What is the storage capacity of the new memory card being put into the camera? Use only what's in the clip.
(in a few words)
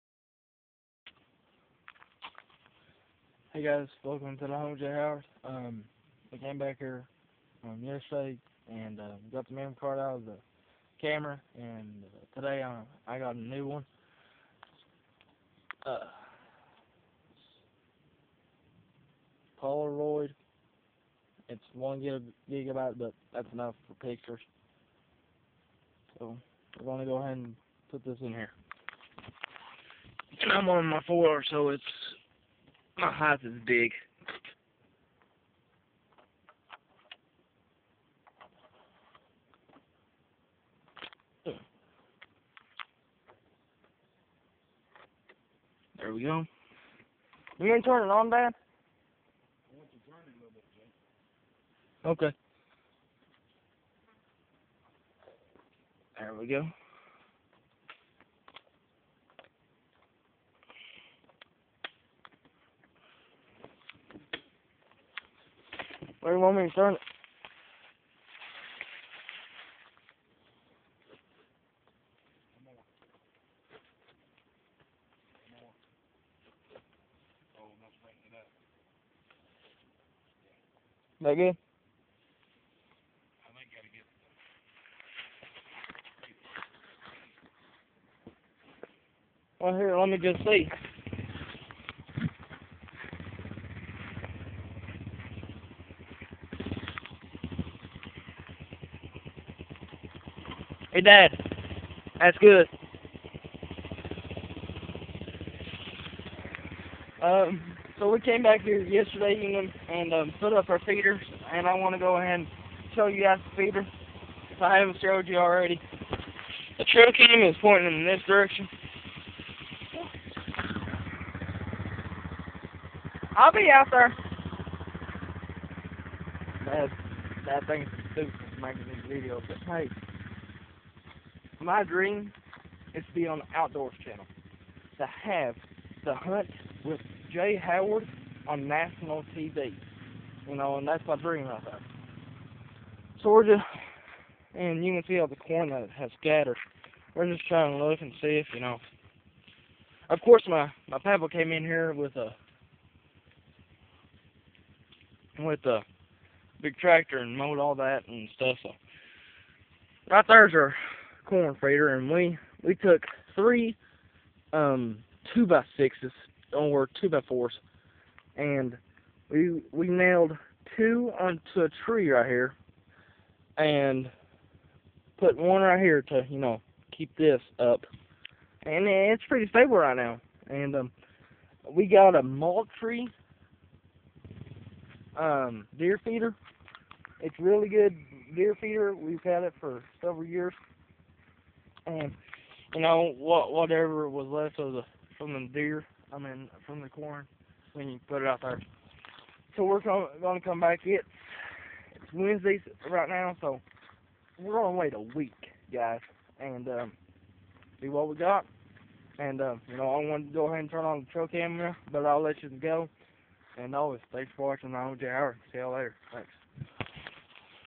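1 gigabyte.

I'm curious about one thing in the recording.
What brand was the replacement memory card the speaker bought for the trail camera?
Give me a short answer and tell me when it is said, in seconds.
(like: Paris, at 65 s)
Polaroid, at 19 s.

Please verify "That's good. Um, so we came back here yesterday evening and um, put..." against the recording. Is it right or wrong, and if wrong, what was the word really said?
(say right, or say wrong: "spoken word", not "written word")
right.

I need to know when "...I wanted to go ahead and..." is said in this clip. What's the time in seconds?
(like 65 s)
209 s.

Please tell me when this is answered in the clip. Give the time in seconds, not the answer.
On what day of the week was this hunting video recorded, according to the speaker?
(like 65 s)
202 s.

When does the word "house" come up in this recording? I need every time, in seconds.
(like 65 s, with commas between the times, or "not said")
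4 s, 33 s.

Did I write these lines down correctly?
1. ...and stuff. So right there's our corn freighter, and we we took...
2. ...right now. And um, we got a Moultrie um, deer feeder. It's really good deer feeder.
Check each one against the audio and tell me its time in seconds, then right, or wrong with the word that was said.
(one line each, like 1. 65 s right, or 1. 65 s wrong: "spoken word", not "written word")
1. 158 s right
2. 179 s right.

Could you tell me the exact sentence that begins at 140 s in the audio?
You know, and that's my dream right there.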